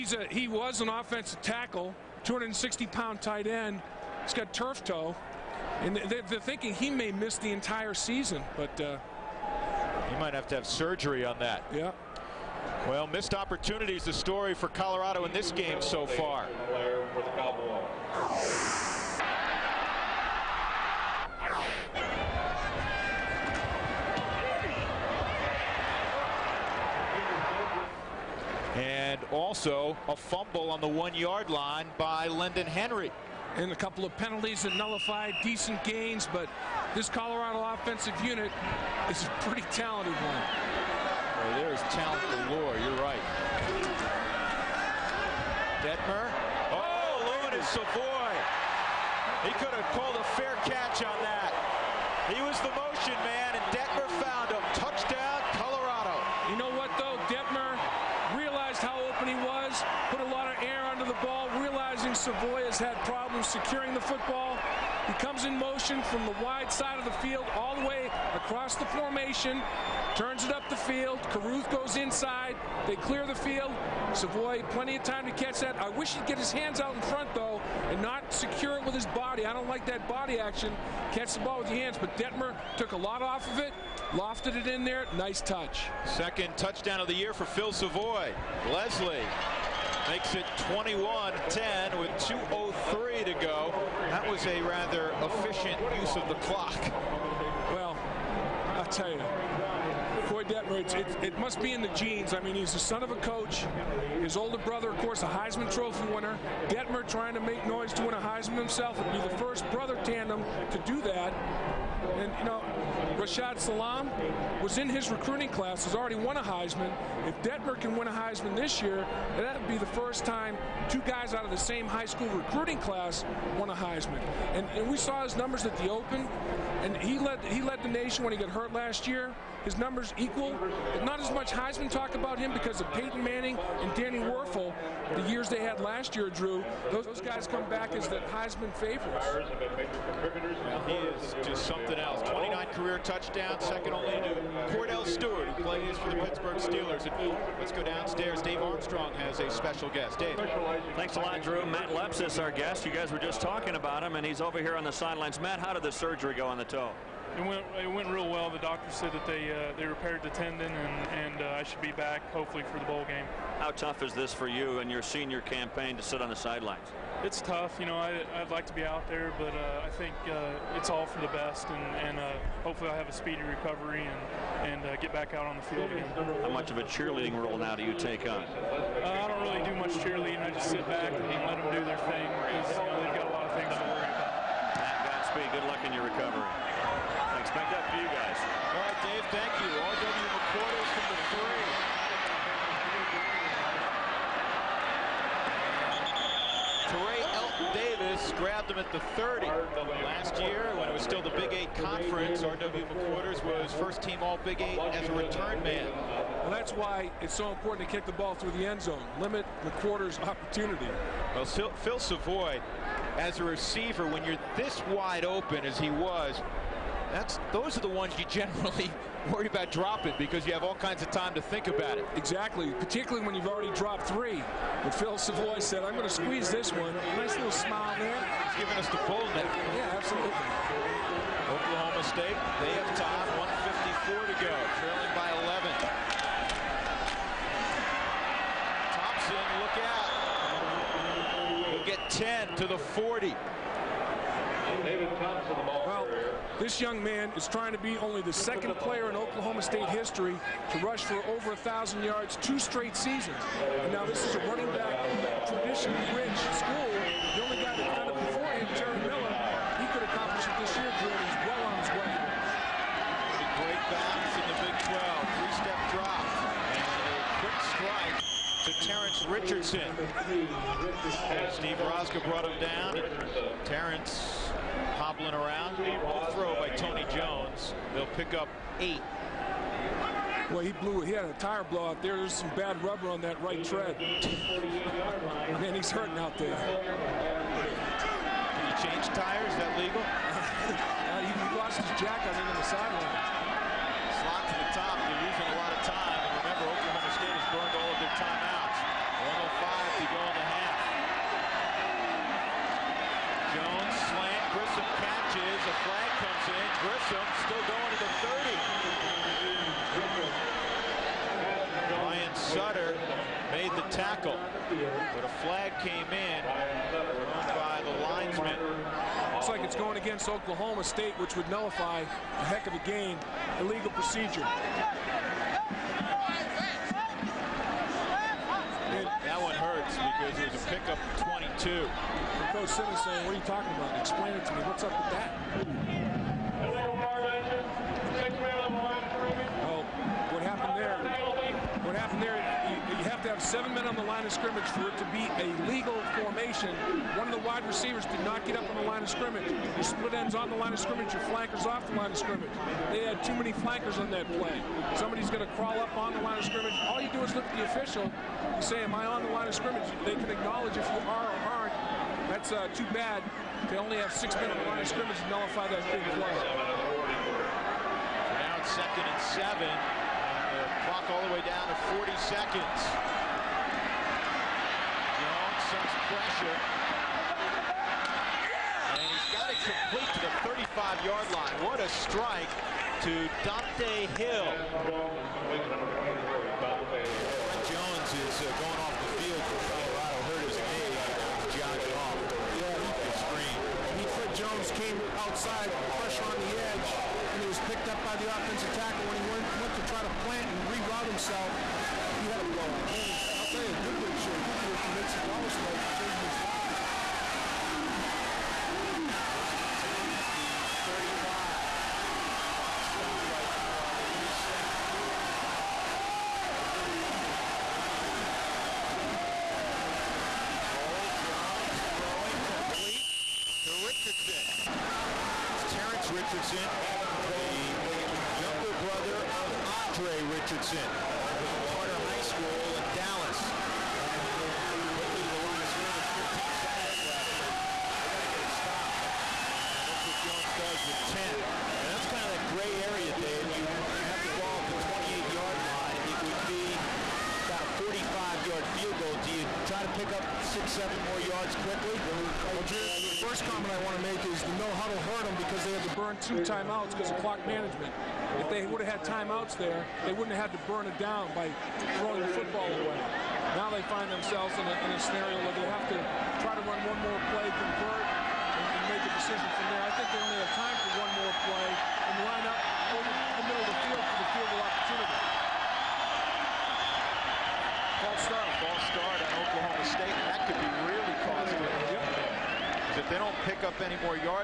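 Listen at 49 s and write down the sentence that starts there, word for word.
He could have called a fair catch on that.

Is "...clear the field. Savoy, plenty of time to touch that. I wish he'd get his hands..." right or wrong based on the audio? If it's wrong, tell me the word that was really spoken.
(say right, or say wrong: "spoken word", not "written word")
wrong: "catch", not "touch".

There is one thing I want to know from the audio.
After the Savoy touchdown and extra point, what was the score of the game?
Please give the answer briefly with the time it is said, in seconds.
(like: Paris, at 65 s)
21-10, at 90 s.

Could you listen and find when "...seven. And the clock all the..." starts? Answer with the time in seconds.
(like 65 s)
369 s.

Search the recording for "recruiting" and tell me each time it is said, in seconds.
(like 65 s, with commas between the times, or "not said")
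115 s, 122 s.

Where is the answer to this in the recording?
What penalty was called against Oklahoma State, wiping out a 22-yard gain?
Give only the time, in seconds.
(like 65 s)
323 s.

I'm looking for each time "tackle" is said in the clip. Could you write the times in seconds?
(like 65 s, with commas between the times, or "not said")
1 s, 398 s.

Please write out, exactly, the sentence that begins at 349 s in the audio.
Your split ends on the line of scrimmage, your flankers off the line of scrimmage.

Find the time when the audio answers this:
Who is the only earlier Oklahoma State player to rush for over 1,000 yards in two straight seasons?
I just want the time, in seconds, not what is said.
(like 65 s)
258 s.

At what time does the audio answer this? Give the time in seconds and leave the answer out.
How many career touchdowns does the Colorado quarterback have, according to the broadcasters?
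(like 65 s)
142 s.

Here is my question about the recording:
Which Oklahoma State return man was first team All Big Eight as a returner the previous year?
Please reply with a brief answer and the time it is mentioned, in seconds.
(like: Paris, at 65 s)
R.W. McQuarters, at 202 s.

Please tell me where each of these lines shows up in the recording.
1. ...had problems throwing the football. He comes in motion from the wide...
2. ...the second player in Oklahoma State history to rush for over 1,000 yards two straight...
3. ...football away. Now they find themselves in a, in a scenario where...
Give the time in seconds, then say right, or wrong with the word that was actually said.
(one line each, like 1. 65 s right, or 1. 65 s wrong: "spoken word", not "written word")
1. 62 s wrong: "securing", not "throwing"
2. 248 s right
3. 462 s right.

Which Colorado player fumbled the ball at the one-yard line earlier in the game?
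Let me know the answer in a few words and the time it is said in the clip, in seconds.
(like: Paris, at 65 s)
Lendon Henry, at 32 s.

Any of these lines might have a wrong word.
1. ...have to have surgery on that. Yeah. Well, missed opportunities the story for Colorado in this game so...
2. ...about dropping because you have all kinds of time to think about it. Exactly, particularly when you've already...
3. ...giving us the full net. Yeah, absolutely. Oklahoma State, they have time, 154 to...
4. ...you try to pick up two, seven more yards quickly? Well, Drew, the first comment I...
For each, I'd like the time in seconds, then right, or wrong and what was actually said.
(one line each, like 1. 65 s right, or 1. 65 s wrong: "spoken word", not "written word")
1. 10 s right
2. 219 s right
3. 228 s right
4. 449 s wrong: "six", not "two".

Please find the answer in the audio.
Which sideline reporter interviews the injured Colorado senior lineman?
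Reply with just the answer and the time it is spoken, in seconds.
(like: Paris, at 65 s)
Dave Armstrong, at 148 s.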